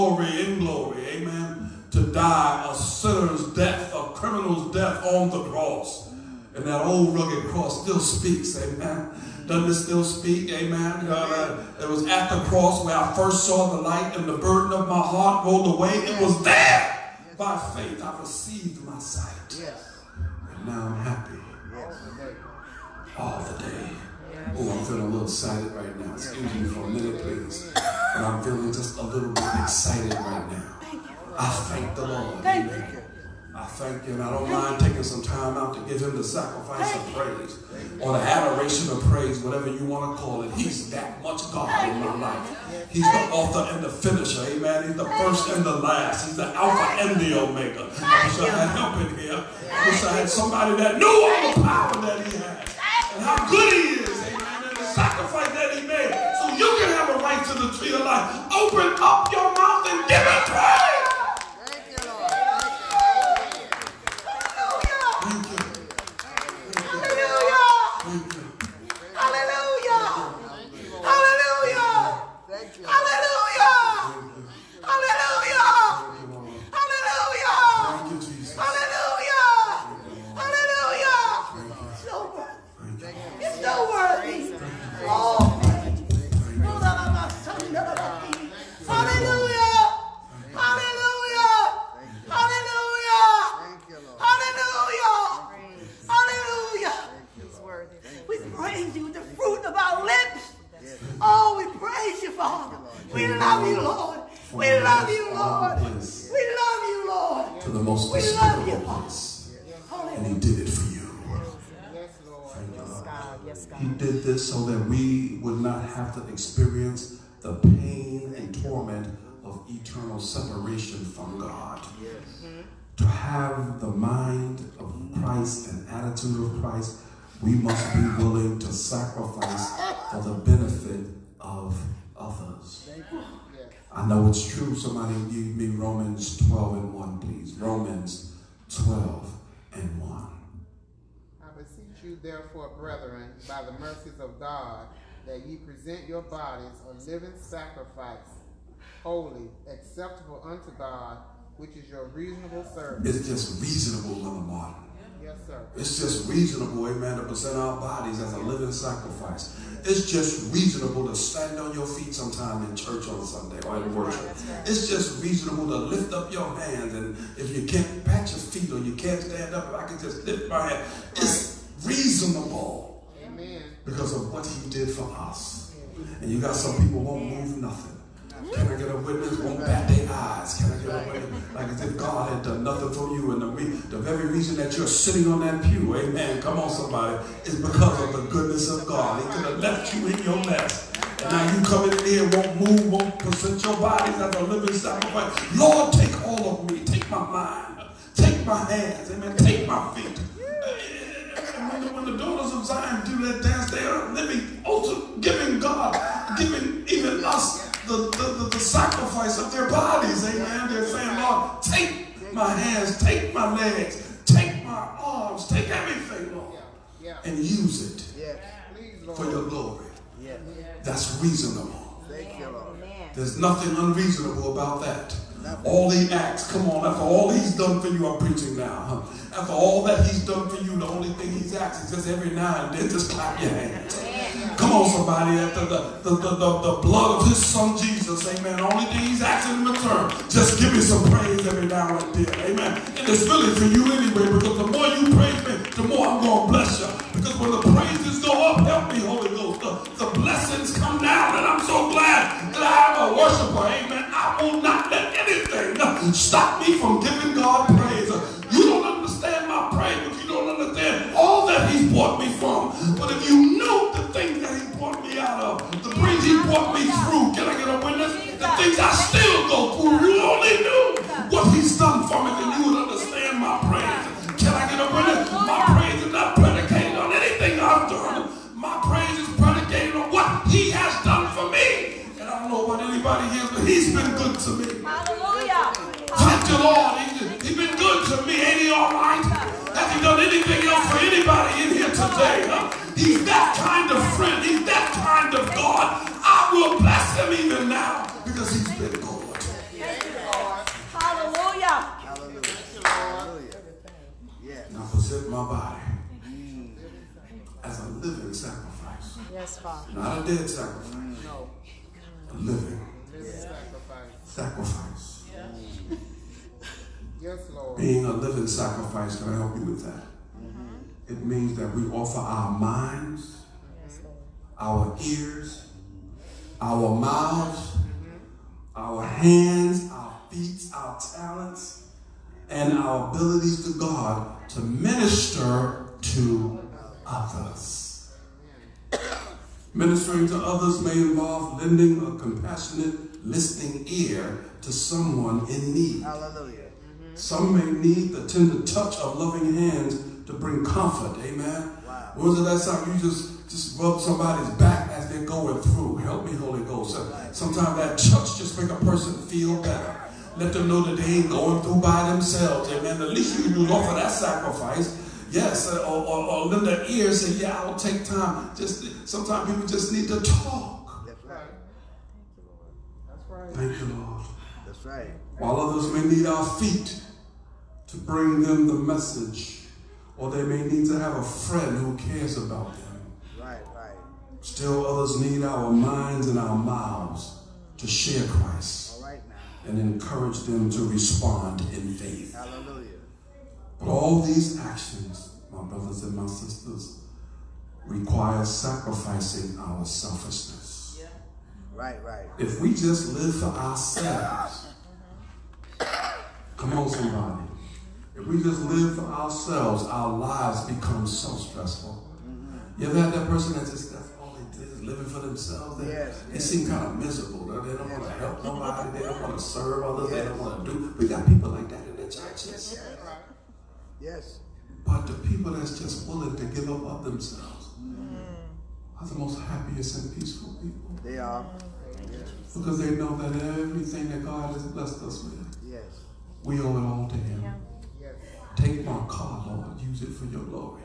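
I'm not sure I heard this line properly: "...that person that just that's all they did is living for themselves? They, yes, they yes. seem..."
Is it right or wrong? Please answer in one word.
right.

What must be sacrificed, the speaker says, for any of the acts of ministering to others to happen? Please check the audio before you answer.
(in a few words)
our selfishness.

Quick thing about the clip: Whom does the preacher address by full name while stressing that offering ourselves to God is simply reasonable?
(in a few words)
Lamar Martin.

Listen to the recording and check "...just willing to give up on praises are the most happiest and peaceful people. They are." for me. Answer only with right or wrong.
wrong.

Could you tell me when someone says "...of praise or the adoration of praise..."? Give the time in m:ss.
0:36.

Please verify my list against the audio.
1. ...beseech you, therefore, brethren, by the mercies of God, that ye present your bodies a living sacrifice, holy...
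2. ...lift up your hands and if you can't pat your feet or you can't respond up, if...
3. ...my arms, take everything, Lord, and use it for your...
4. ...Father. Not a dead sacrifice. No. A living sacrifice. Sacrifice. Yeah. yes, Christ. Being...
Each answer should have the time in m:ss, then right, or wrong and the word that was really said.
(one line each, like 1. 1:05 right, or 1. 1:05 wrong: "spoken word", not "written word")
1. 2:21 right
2. 2:45 wrong: "stand", not "respond"
3. 3:34 right
4. 5:09 wrong: "Lord", not "Christ".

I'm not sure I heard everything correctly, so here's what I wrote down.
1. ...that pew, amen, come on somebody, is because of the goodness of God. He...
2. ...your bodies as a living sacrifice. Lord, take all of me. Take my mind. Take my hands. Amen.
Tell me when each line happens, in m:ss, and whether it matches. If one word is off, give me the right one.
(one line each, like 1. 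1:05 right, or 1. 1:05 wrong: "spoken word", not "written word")
1. 3:05 right
2. 3:13 right.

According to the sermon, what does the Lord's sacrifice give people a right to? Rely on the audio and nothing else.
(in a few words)
the tree of life.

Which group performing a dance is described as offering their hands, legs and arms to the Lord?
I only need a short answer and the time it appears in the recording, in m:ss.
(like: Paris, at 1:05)
daughters of Zion, at 3:22.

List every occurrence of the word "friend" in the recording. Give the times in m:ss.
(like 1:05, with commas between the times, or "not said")
4:54, 6:21.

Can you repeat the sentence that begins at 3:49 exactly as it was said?
After all that he's done for you, the only thing he's asked is just every now and then, just clap your hands.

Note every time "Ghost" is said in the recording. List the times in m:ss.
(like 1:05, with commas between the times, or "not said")
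4:09, 5:56.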